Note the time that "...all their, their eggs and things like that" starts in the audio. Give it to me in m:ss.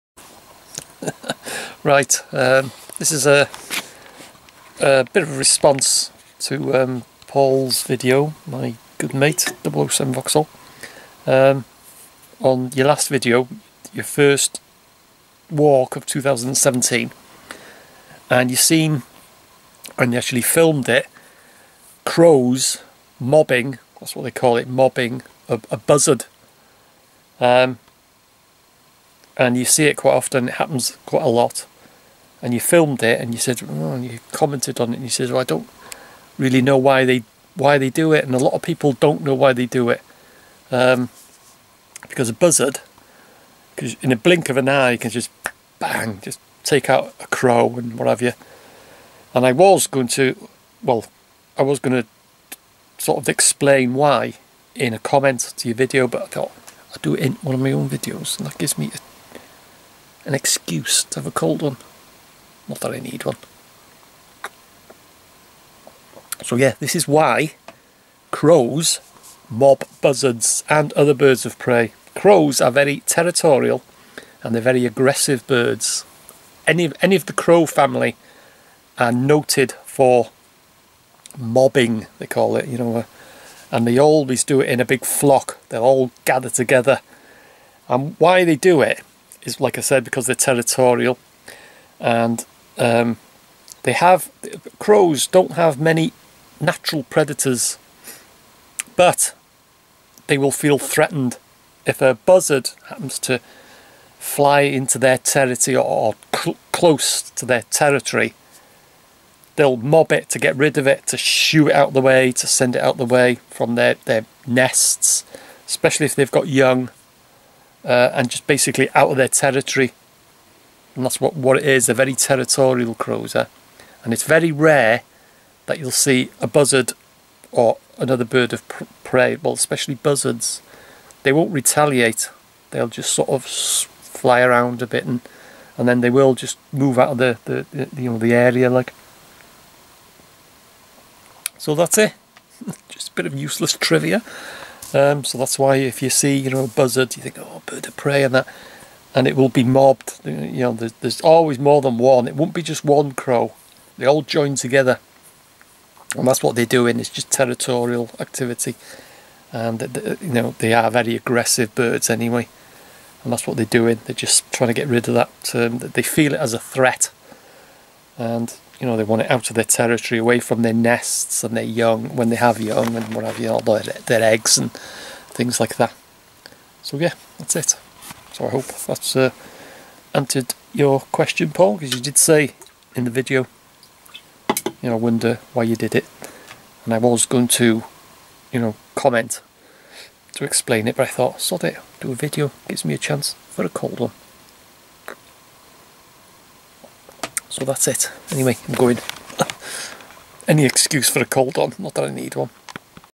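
2:53.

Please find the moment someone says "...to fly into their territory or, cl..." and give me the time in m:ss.
1:43.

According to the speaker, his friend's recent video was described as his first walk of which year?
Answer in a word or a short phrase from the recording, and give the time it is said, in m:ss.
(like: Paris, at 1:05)
2017, at 0:16.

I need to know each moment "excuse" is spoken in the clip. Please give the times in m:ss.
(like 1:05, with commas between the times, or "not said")
1:00, 3:20.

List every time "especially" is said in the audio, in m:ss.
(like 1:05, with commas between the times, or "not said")
1:55, 2:09.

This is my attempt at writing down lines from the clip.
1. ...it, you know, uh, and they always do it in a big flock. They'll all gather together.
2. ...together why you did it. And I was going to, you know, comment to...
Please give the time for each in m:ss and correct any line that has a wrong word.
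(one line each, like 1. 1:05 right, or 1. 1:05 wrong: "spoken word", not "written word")
1. 1:22 right
2. 3:04 wrong: "wonder", not "together".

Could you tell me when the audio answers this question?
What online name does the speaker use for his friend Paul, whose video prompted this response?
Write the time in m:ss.
0:09.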